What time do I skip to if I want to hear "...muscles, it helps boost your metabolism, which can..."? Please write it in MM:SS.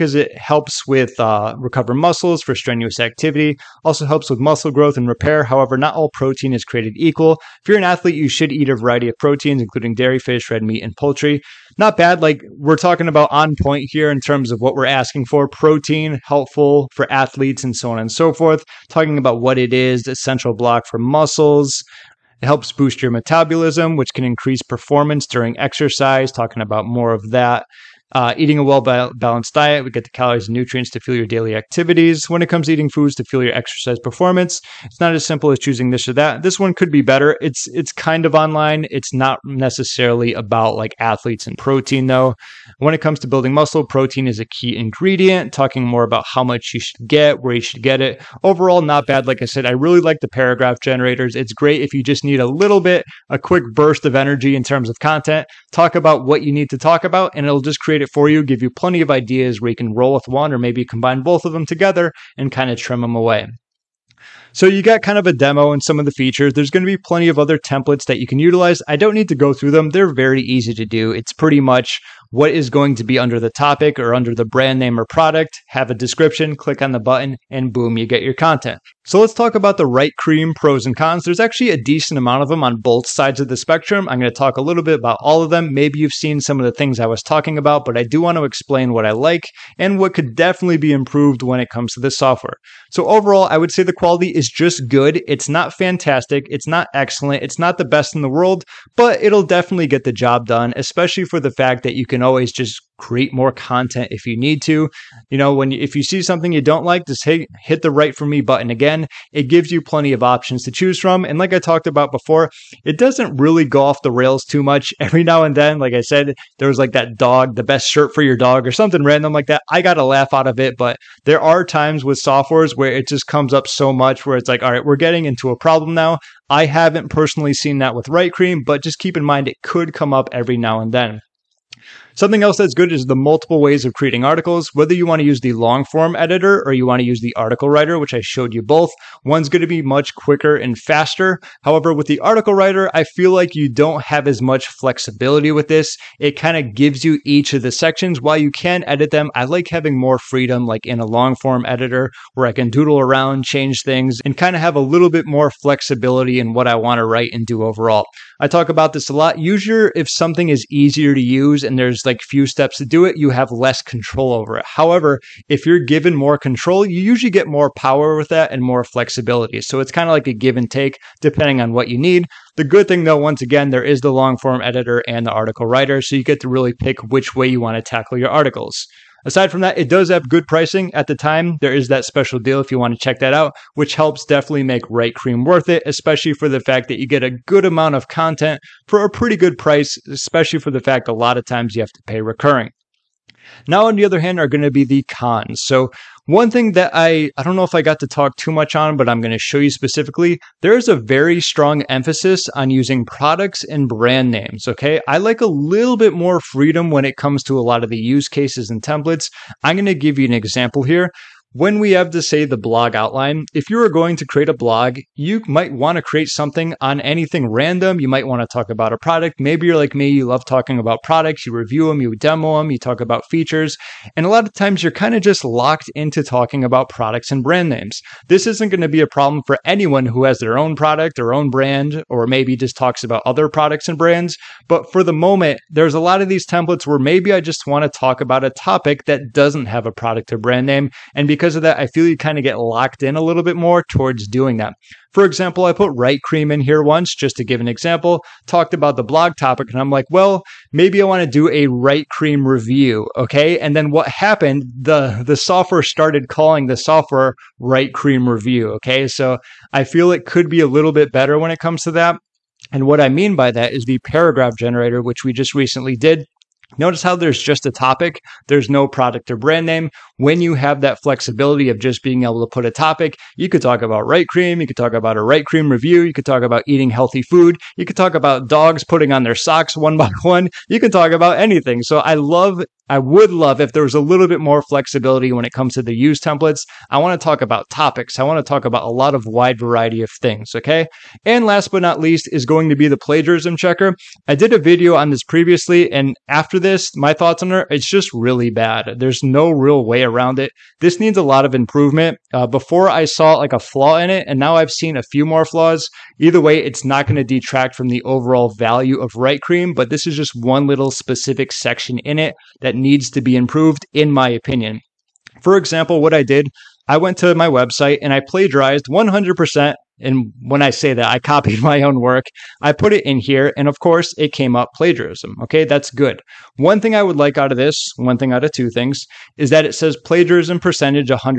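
00:20.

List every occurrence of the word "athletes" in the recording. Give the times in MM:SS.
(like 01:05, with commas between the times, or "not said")
00:07, 00:17, 00:40.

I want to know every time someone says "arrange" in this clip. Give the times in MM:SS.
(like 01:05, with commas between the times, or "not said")
not said.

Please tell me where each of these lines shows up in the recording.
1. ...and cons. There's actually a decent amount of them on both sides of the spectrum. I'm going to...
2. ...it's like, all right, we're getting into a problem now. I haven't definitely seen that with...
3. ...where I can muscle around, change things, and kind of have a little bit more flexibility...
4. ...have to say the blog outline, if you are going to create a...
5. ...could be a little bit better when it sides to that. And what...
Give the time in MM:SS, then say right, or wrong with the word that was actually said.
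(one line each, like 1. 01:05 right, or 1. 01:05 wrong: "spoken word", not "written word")
1. 01:20 right
2. 02:04 wrong: "personally", not "definitely"
3. 02:32 wrong: "doodle", not "muscle"
4. 03:31 right
5. 04:20 wrong: "comes", not "sides".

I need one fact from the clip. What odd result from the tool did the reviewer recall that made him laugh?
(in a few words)
the best shirt for your dog.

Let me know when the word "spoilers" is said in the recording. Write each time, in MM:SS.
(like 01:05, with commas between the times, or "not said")
not said.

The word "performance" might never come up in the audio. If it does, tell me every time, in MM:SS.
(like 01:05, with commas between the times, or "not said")
00:24, 00:34.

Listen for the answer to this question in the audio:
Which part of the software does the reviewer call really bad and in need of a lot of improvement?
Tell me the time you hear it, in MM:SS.
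04:52.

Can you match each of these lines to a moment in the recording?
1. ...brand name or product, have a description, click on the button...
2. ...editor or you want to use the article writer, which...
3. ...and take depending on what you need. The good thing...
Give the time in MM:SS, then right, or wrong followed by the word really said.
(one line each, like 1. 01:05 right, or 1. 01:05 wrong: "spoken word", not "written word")
1. 01:14 right
2. 02:16 right
3. 02:50 right.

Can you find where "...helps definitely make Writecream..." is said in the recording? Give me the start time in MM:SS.
03:03.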